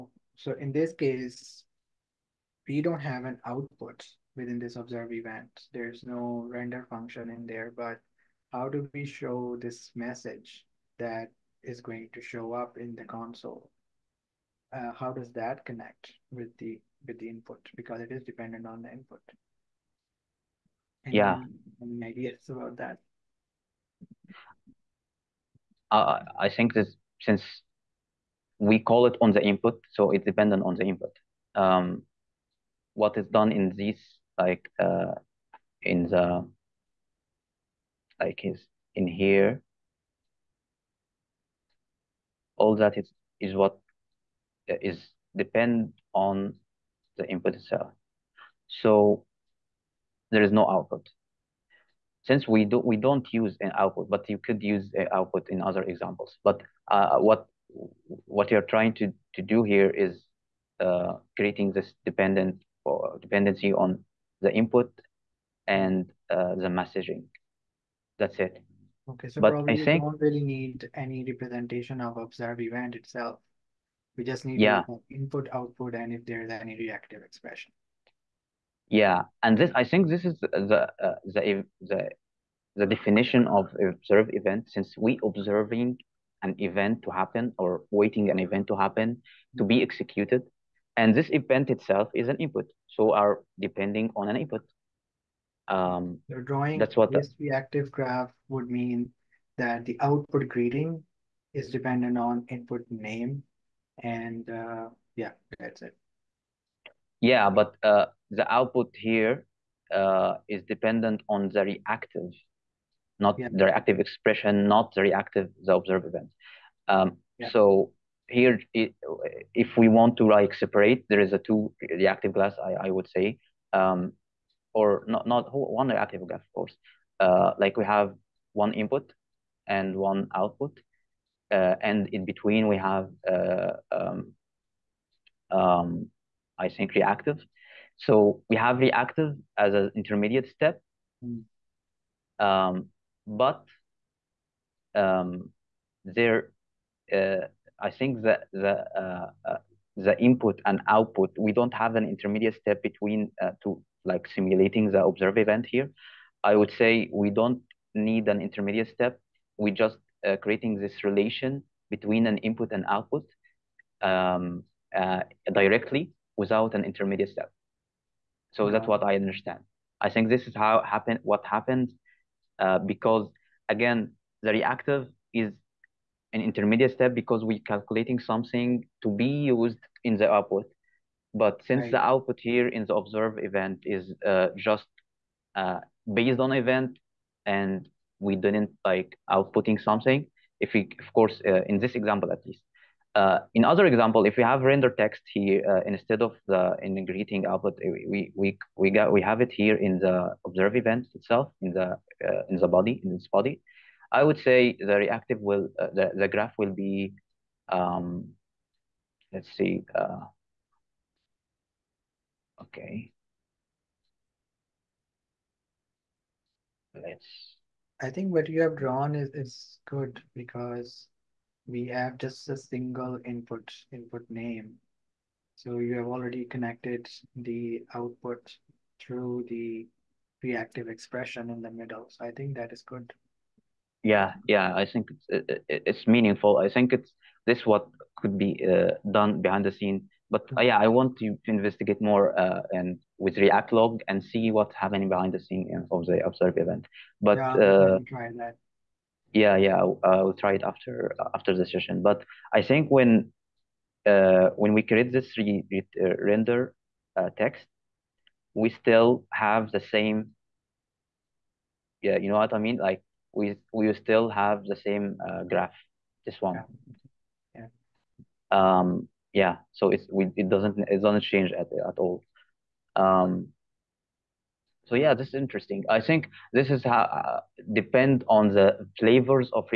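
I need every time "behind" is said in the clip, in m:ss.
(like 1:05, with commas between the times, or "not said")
3:59, 4:05.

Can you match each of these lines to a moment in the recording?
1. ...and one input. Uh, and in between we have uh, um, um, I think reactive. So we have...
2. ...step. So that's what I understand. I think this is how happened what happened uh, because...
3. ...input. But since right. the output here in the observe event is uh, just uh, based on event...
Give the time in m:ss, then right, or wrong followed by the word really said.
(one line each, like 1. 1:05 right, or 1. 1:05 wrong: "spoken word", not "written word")
1. 2:09 wrong: "output", not "input"
2. 2:47 right
3. 3:00 wrong: "output", not "input".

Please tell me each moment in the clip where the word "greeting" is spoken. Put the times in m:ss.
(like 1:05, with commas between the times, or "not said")
1:40, 3:16.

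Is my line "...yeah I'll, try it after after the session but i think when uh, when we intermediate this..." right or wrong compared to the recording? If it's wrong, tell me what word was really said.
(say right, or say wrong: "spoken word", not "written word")
wrong: "create", not "intermediate".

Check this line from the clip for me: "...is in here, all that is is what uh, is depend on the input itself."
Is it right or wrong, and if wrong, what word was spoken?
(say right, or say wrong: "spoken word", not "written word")
right.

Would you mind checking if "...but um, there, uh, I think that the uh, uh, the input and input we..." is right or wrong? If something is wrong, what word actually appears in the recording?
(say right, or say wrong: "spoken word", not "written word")
wrong: "output", not "input".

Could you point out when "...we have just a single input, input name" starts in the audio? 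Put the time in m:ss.
3:41.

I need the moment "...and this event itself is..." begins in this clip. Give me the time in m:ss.
1:30.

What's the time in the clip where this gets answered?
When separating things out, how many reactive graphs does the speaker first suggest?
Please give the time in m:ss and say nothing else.
2:01.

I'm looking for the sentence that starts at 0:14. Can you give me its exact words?
Uh, how does that connect with the with the input?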